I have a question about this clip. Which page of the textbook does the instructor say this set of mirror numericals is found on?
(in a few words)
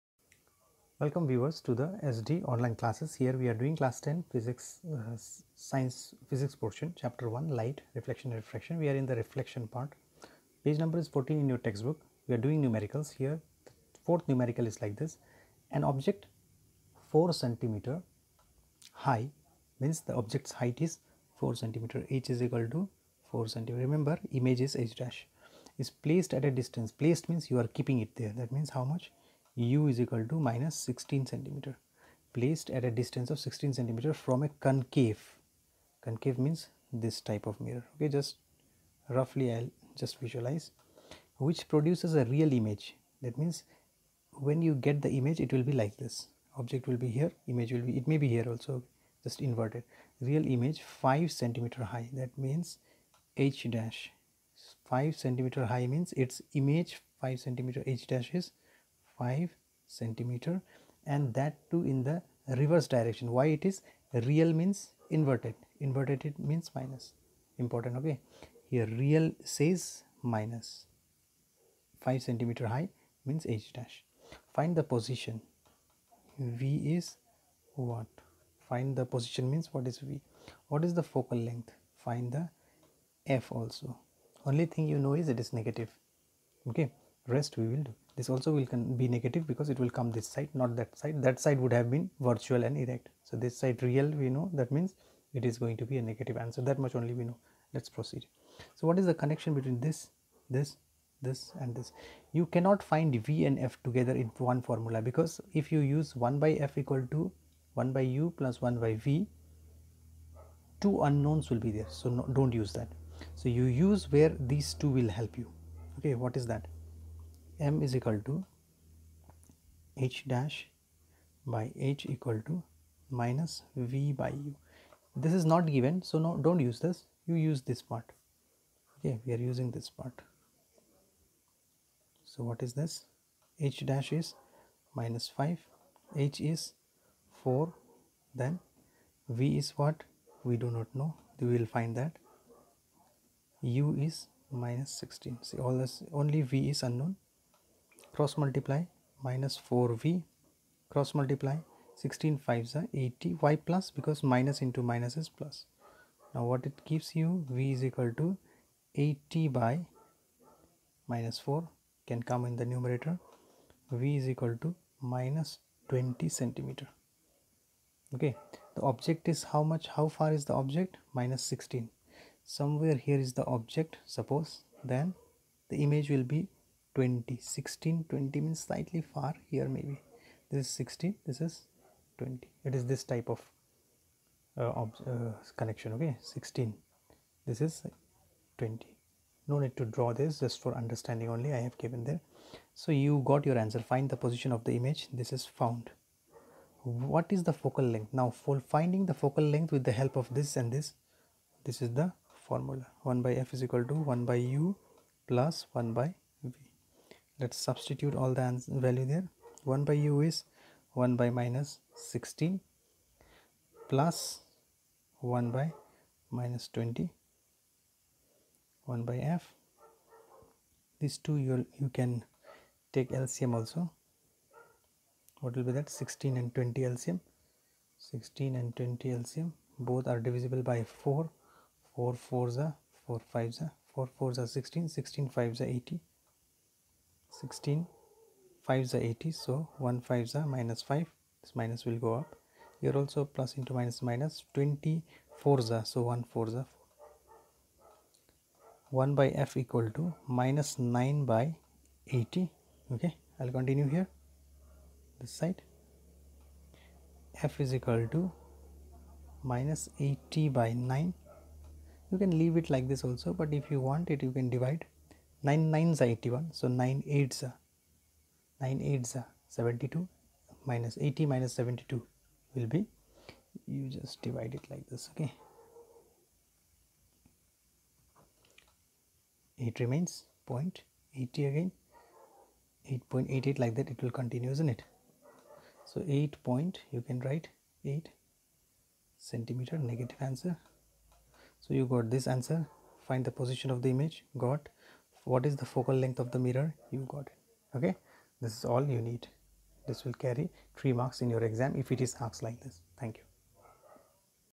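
14.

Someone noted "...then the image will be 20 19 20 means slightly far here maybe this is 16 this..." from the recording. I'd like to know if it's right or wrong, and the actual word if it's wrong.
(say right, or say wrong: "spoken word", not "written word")
wrong: "16", not "19".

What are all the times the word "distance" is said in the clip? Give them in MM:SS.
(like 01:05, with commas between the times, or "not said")
00:26, 00:32.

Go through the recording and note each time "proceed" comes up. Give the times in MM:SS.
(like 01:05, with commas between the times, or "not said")
01:37.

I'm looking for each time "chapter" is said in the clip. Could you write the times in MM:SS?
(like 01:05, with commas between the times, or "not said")
00:06.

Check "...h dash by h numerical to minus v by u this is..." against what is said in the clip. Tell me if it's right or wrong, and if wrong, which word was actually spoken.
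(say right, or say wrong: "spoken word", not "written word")
wrong: "equal", not "numerical".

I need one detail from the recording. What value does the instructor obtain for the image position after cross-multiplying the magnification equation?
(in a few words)
-20 cm.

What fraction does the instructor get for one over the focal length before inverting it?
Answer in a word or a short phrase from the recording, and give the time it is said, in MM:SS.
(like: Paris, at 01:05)
-9/80, at 04:10.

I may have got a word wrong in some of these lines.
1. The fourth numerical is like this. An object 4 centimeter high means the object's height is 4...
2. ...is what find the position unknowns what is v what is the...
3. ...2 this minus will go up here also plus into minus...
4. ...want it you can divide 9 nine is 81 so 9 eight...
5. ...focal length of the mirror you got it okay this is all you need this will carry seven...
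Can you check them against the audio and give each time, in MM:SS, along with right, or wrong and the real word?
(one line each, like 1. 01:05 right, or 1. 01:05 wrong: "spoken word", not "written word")
1. 00:13 right
2. 01:16 wrong: "means", not "unknowns"
3. 04:00 wrong: "5", not "2"
4. 04:23 right
5. 04:55 wrong: "three", not "seven".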